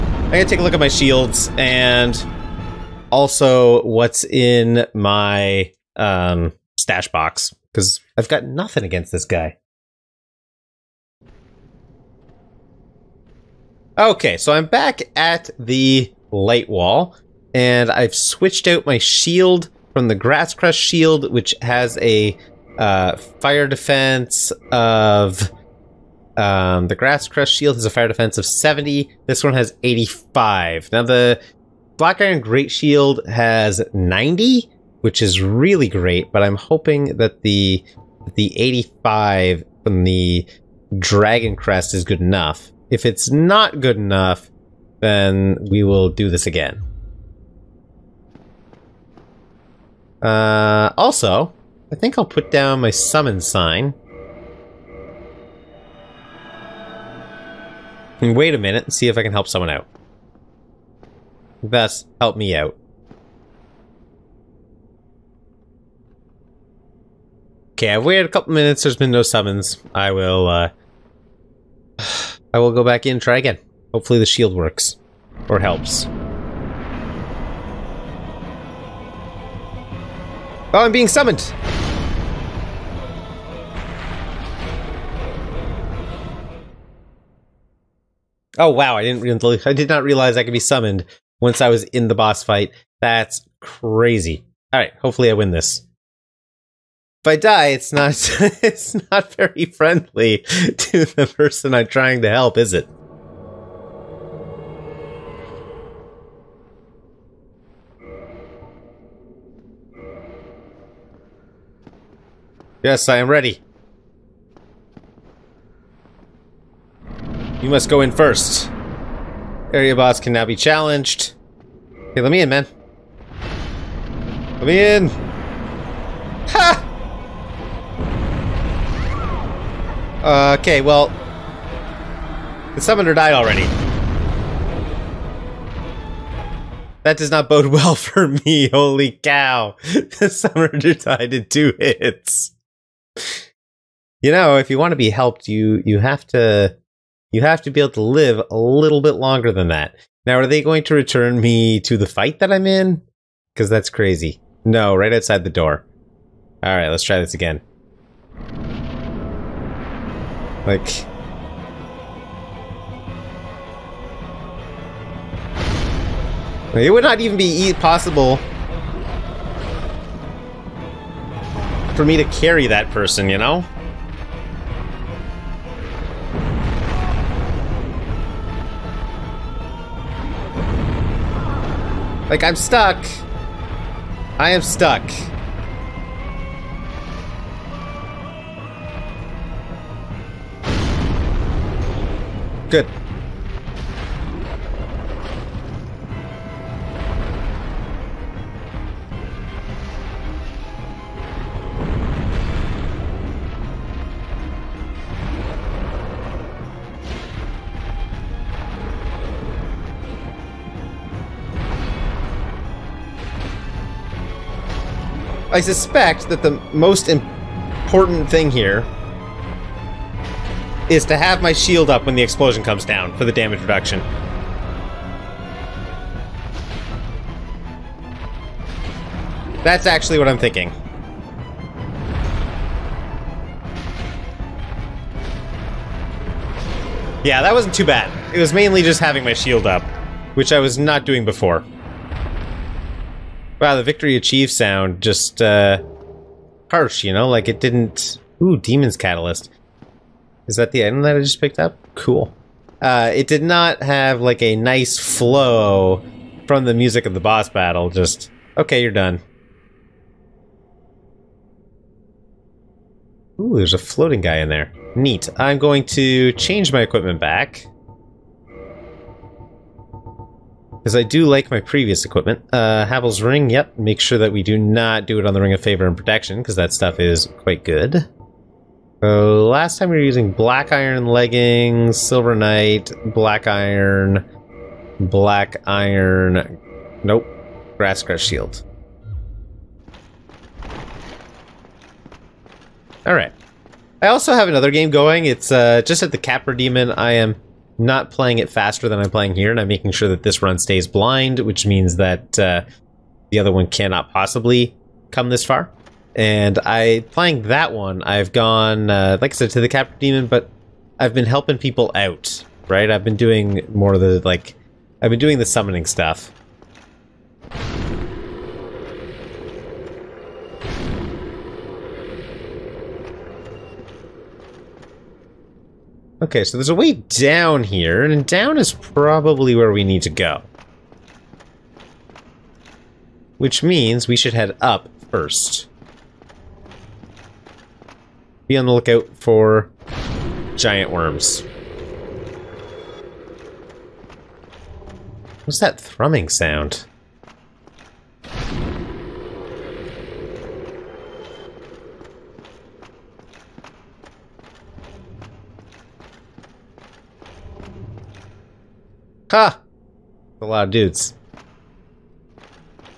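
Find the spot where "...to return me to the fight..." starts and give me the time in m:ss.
2:30.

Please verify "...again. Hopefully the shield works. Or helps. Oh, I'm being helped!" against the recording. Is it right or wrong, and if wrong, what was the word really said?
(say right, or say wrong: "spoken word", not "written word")
wrong: "summoned", not "helped".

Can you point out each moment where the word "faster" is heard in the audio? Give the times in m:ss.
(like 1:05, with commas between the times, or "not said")
4:58.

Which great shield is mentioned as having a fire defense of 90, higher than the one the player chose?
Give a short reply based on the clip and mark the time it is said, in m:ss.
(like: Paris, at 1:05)
Black Iron Great Shield, at 0:31.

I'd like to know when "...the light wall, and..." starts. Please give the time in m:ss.
0:15.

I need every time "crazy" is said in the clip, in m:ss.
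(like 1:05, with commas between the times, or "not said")
1:33, 2:33.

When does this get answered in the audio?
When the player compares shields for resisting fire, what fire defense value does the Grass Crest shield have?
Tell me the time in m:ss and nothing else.
0:28.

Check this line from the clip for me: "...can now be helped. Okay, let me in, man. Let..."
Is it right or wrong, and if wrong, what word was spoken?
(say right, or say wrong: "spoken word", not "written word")
wrong: "challenged", not "helped".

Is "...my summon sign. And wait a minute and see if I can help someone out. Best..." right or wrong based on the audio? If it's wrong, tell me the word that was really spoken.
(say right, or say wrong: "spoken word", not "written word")
right.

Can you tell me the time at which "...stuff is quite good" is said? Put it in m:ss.
4:36.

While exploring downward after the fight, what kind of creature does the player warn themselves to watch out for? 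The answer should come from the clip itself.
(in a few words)
giant worms.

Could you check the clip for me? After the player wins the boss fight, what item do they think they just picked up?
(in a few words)
Demon's Catalyst.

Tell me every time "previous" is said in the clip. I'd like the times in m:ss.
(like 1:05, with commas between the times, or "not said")
4:31.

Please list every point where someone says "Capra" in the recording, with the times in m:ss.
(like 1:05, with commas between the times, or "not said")
4:56, 5:09.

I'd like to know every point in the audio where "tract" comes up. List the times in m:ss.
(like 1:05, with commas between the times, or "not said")
not said.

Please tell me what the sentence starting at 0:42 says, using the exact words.
If it's not good enough, then we will do this again.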